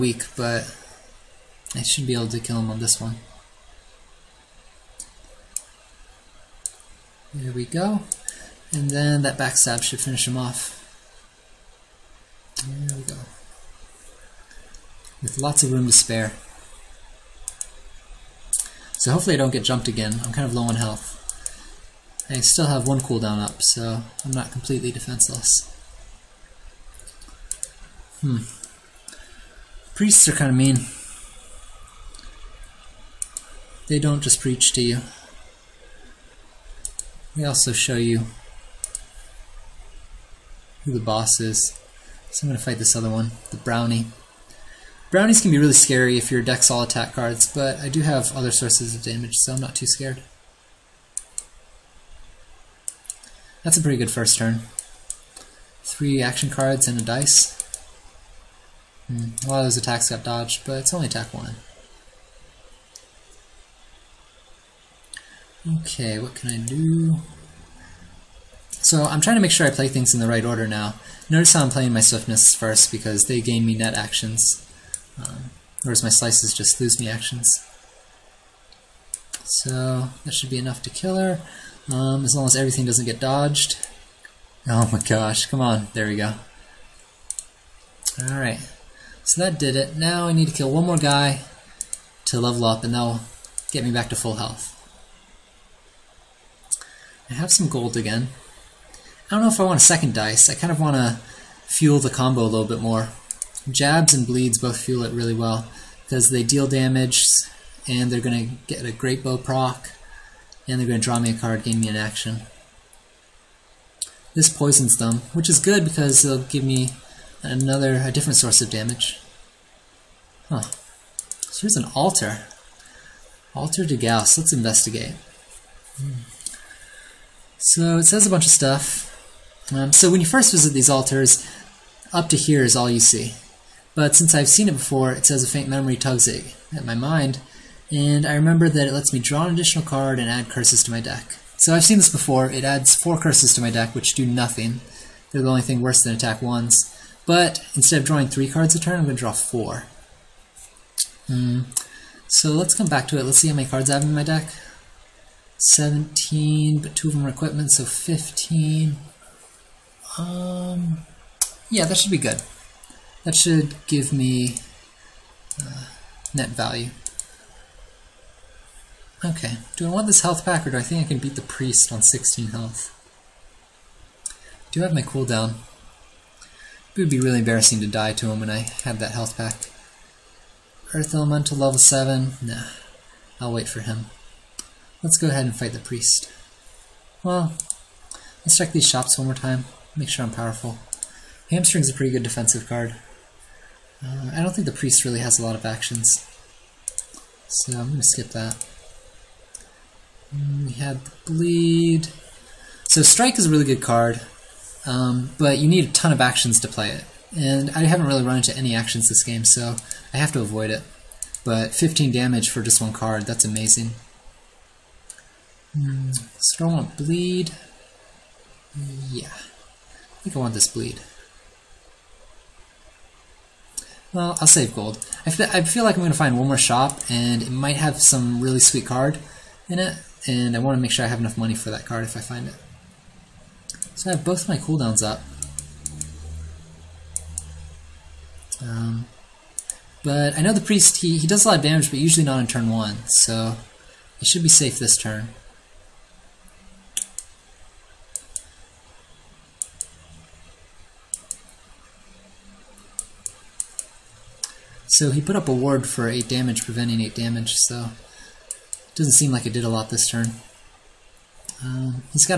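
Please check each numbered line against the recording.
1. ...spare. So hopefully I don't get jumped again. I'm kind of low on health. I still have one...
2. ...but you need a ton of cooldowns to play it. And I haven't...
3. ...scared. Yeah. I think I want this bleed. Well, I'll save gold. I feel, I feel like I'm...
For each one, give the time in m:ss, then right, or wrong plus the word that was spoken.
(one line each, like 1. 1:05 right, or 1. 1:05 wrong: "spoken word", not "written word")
1. 0:15 right
2. 3:25 wrong: "actions", not "cooldowns"
3. 3:36 wrong: "bleed", not "scared".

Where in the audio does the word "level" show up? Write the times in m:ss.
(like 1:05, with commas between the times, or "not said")
1:32, 3:01.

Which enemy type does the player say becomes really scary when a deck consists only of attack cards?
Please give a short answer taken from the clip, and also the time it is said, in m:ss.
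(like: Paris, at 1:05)
brownie, at 0:43.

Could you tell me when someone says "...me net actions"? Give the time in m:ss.
1:13.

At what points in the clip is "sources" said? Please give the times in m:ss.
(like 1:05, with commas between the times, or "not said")
0:48, 1:58.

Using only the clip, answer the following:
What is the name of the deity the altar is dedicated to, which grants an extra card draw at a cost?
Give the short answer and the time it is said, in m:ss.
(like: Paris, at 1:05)
Gauss, at 2:03.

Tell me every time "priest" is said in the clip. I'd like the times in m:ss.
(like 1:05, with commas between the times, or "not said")
0:29, 2:51, 3:05, 3:14, 4:00.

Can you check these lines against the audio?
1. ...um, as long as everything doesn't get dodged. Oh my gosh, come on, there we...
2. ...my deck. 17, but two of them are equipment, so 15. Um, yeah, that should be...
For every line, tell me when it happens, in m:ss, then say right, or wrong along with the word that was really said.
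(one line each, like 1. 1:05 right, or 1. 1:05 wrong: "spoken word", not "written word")
1. 1:21 right
2. 2:34 right.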